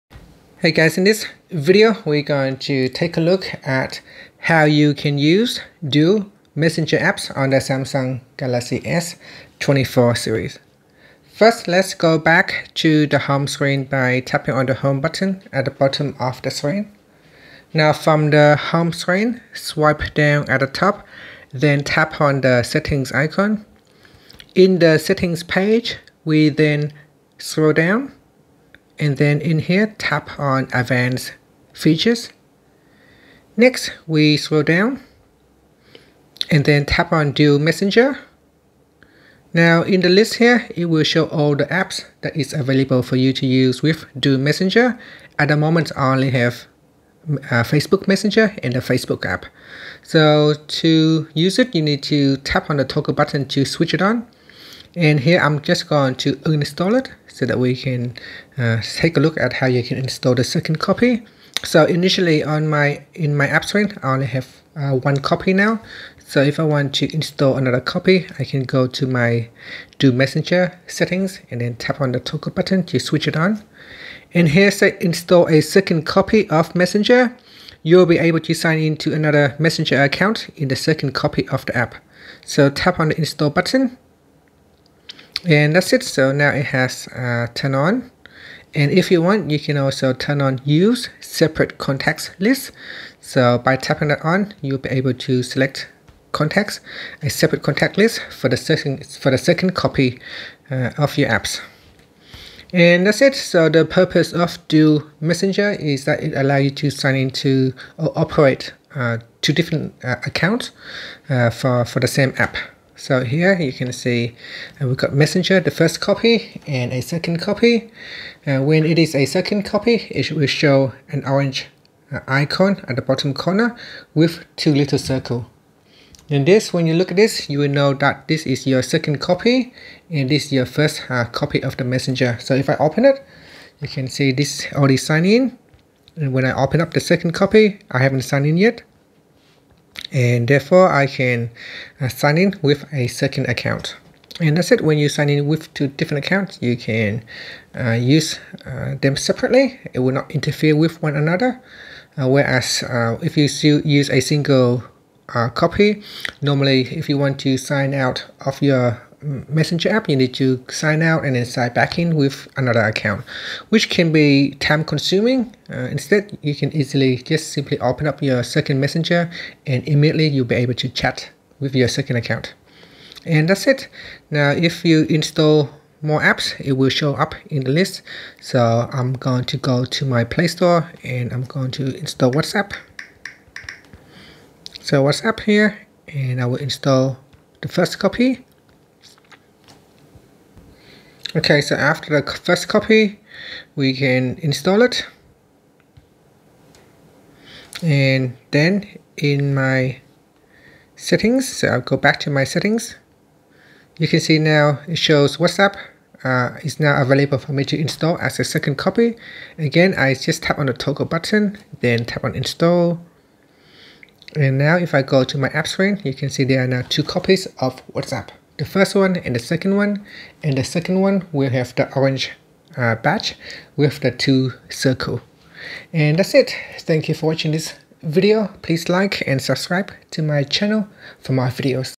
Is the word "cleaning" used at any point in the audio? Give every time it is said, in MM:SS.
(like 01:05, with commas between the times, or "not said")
not said.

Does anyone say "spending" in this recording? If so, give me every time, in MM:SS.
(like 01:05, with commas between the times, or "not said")
not said.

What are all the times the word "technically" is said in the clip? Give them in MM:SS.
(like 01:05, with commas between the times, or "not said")
not said.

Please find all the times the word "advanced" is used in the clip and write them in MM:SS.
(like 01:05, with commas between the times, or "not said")
00:30.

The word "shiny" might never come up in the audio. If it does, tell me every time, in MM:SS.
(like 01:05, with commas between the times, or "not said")
not said.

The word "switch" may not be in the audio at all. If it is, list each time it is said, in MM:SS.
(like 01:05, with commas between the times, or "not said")
00:53, 01:12.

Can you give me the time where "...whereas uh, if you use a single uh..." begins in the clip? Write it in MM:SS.
02:32.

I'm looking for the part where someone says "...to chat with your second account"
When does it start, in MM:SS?
02:50.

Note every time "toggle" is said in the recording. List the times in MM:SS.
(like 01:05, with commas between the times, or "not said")
00:52, 01:12, 03:30.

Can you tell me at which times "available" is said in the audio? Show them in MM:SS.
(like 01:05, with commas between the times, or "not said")
00:42, 03:27.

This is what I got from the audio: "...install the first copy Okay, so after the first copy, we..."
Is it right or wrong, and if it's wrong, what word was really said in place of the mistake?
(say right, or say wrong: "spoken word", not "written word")
right.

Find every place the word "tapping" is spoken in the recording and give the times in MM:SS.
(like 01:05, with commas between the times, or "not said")
00:14, 01:33.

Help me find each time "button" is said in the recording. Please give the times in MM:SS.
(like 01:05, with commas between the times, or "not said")
00:15, 00:53, 01:12, 01:23, 03:31.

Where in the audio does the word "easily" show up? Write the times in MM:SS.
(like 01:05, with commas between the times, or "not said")
02:46.